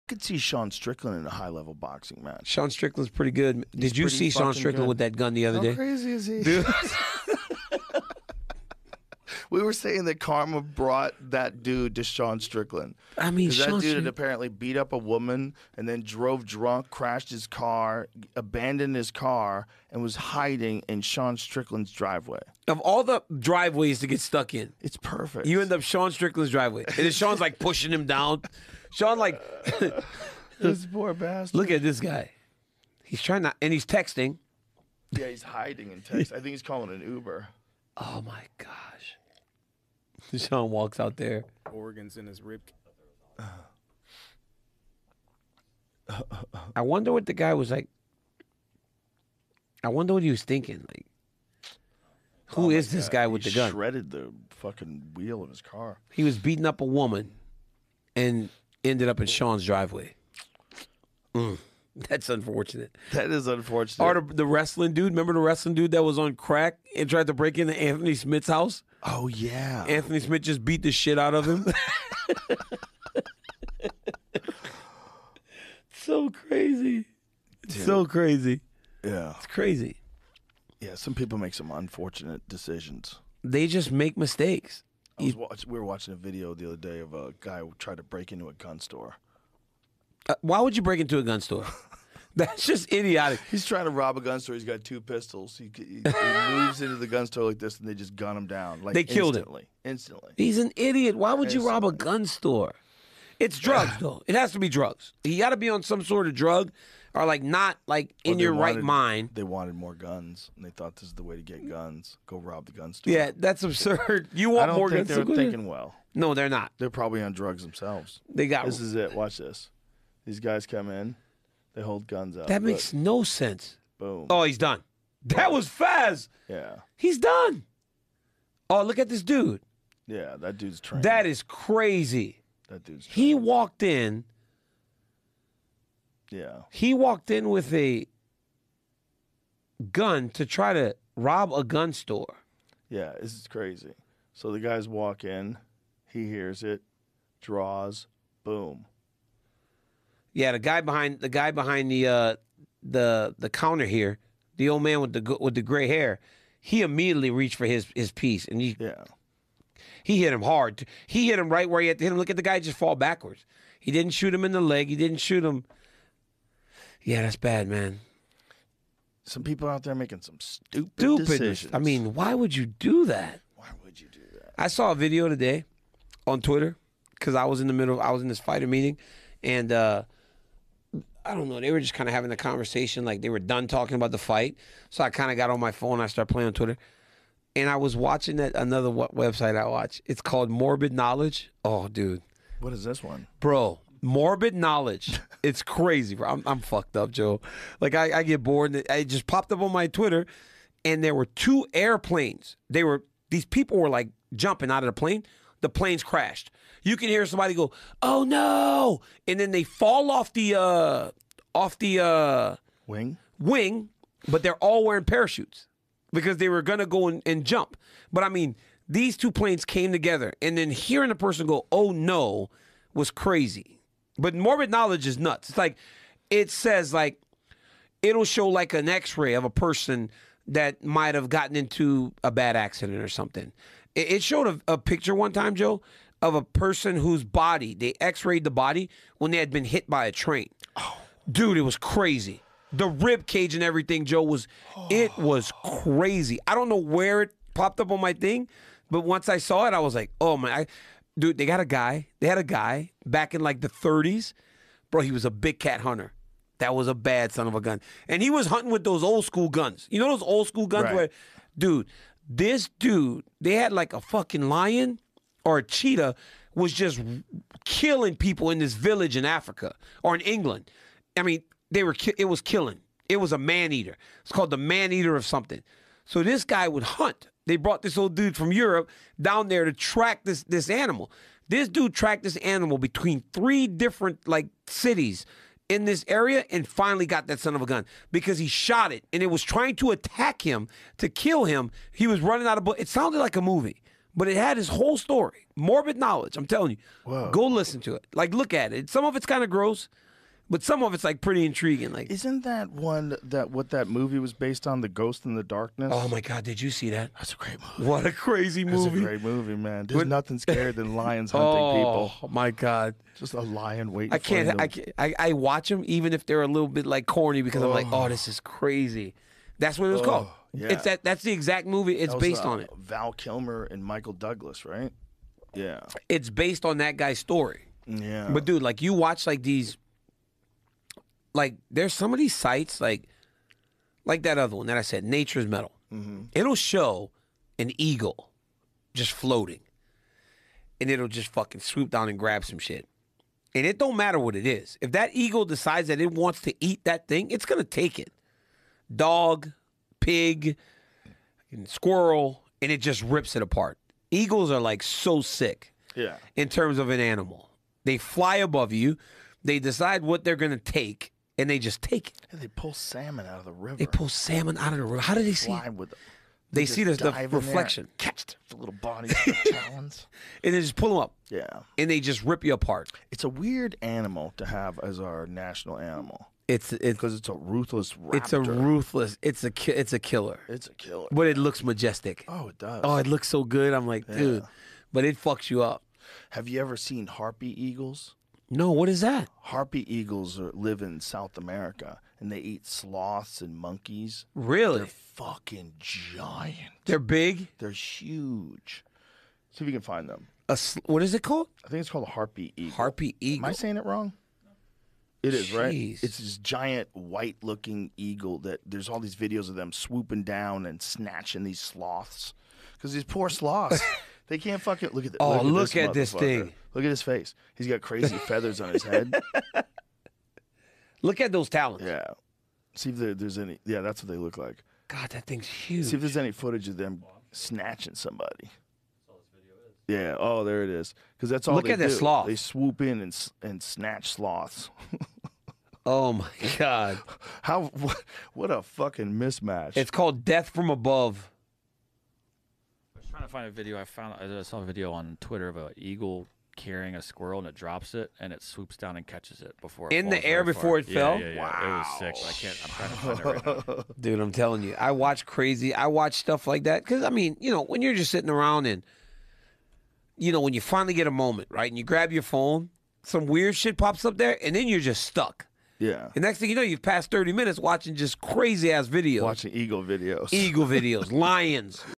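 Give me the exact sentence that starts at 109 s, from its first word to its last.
They wanted more guns, and they thought this is the way to get guns.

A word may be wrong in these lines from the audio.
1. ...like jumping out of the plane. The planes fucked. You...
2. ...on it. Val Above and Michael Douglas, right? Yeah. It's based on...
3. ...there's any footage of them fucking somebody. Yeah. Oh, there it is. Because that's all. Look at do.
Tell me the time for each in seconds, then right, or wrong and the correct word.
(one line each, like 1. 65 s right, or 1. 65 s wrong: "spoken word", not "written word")
1. 203 s wrong: "crashed", not "fucked"
2. 322 s wrong: "Kilmer", not "Above"
3. 425 s wrong: "snatching", not "fucking".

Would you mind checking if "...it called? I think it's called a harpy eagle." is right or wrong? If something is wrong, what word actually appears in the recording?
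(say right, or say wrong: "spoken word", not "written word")
right.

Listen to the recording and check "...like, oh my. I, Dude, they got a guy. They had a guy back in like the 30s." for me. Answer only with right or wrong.
right.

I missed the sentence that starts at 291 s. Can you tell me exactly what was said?
He was running out of bullets.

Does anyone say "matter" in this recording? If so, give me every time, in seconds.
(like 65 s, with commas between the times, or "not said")
343 s.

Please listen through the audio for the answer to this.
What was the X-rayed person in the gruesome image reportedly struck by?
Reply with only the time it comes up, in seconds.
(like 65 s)
240 s.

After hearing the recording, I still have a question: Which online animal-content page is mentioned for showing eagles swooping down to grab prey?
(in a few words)
Nature's Metal.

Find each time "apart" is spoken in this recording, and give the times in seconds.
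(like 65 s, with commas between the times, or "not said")
353 s, 372 s.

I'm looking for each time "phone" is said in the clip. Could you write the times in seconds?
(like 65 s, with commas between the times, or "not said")
185 s, 462 s.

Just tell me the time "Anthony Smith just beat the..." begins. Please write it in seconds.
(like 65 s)
69 s.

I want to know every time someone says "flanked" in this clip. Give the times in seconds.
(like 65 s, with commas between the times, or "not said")
not said.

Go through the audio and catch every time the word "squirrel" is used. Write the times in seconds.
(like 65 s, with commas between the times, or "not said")
351 s, 447 s.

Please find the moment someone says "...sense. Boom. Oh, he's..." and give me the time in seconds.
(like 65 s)
123 s.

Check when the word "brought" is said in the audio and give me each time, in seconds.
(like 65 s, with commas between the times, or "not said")
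10 s, 277 s.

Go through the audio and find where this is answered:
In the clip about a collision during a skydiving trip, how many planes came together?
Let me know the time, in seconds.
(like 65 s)
219 s.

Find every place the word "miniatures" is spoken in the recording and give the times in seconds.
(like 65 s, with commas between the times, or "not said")
not said.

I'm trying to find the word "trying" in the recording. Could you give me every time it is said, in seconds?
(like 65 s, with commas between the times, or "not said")
33 s, 93 s, 289 s, 443 s, 452 s.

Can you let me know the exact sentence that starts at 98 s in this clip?
Like they killed instantly, him instantly.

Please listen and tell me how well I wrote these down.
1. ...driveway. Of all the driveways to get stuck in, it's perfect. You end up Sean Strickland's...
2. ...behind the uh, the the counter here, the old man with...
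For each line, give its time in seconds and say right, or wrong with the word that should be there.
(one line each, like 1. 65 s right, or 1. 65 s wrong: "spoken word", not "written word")
1. 21 s right
2. 151 s right.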